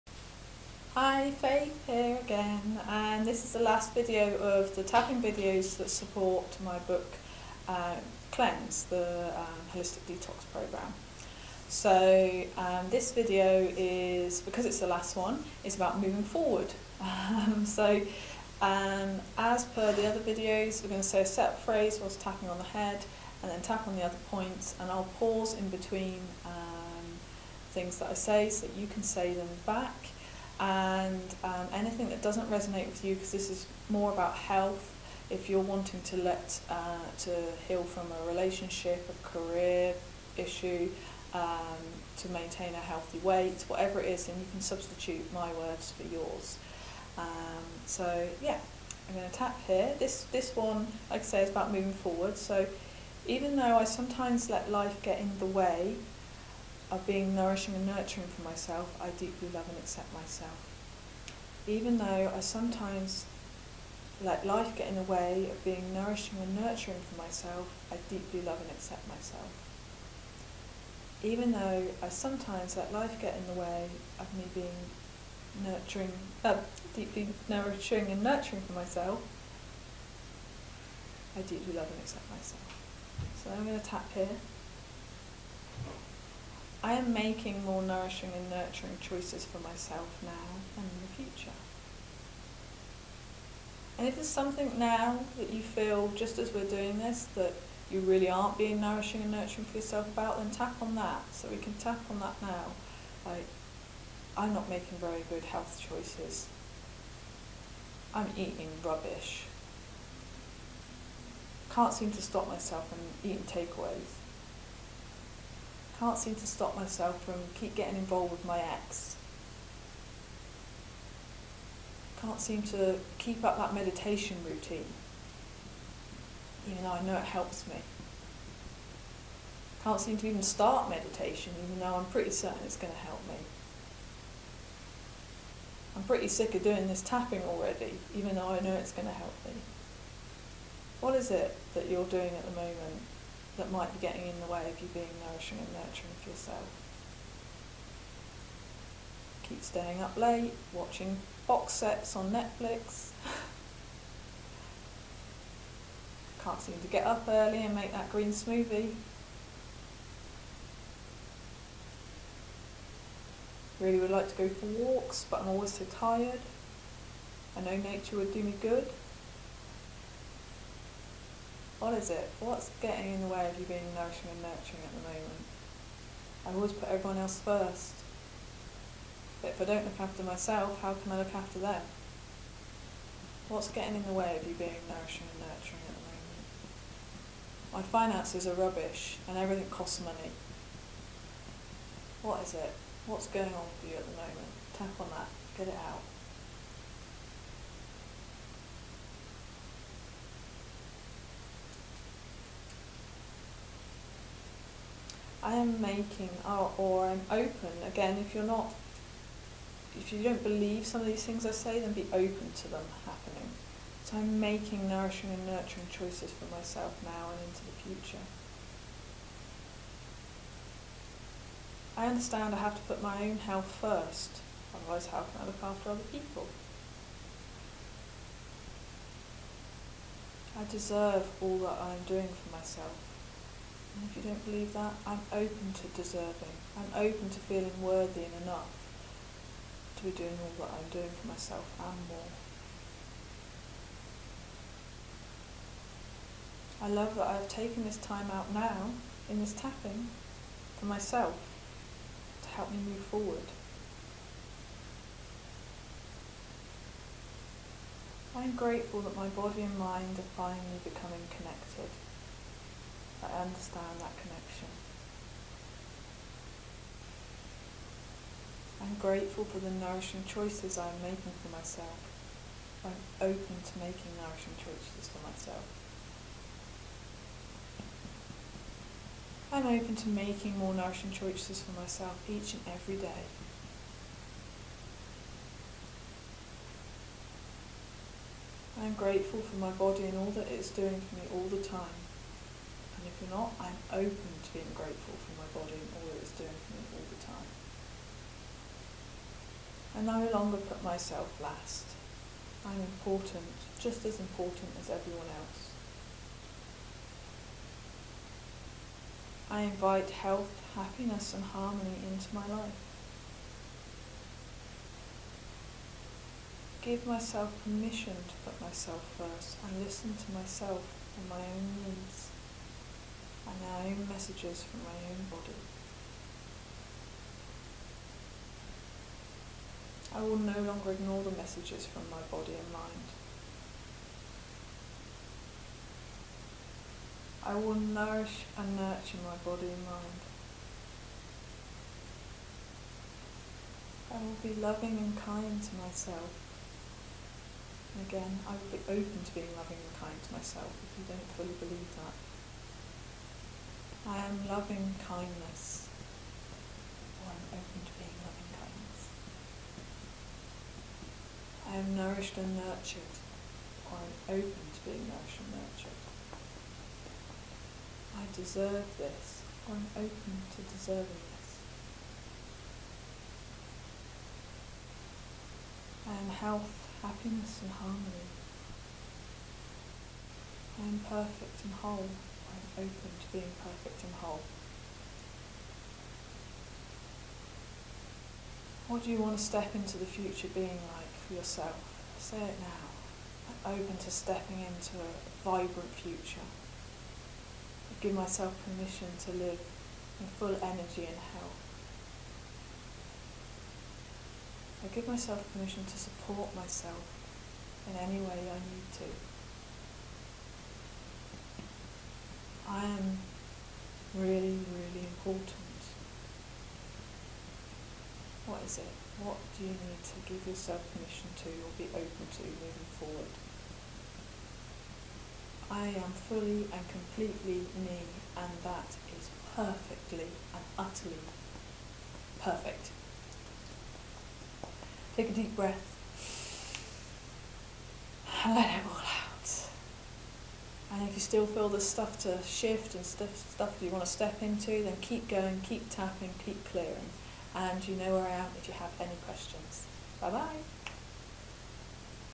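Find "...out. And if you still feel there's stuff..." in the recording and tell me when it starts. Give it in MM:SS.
07:18.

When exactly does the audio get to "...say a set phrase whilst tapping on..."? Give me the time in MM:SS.
00:21.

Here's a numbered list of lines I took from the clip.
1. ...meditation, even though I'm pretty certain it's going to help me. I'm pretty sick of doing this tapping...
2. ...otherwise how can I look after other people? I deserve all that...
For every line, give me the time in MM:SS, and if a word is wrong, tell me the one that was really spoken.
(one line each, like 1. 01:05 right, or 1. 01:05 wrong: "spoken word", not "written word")
1. 02:10 right
2. 03:44 right.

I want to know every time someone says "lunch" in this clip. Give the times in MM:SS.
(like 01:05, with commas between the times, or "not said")
not said.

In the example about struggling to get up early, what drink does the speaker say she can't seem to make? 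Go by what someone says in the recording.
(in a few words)
green smoothie.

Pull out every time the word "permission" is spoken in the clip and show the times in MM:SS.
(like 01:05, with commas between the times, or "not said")
05:17, 06:38, 06:45, 07:00.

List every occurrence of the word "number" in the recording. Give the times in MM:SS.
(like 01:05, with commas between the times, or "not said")
not said.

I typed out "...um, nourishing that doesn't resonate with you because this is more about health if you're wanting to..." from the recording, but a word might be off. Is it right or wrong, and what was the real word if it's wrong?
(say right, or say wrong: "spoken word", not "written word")
wrong: "anything", not "nourishing".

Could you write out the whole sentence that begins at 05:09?
I invite health, happiness and harmony into my life.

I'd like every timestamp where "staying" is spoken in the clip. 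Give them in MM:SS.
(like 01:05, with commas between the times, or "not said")
02:29.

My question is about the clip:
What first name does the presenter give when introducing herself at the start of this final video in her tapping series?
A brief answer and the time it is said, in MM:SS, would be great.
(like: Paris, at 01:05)
Faith, at 00:01.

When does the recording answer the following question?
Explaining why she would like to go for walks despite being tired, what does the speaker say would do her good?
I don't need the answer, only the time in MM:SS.
02:47.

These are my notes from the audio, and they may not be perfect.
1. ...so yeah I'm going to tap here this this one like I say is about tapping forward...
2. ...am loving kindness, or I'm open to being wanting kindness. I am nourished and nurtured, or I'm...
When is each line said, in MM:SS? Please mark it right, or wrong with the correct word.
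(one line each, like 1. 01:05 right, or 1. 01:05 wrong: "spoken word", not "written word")
1. 00:47 wrong: "moving", not "tapping"
2. 05:54 wrong: "loving", not "wanting".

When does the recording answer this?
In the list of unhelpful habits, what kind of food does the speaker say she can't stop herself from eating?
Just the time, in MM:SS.
01:53.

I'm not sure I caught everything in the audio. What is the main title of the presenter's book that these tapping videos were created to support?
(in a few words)
Cleanse.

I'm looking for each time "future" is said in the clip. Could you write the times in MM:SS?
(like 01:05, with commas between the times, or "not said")
01:31, 03:38, 06:30, 06:35.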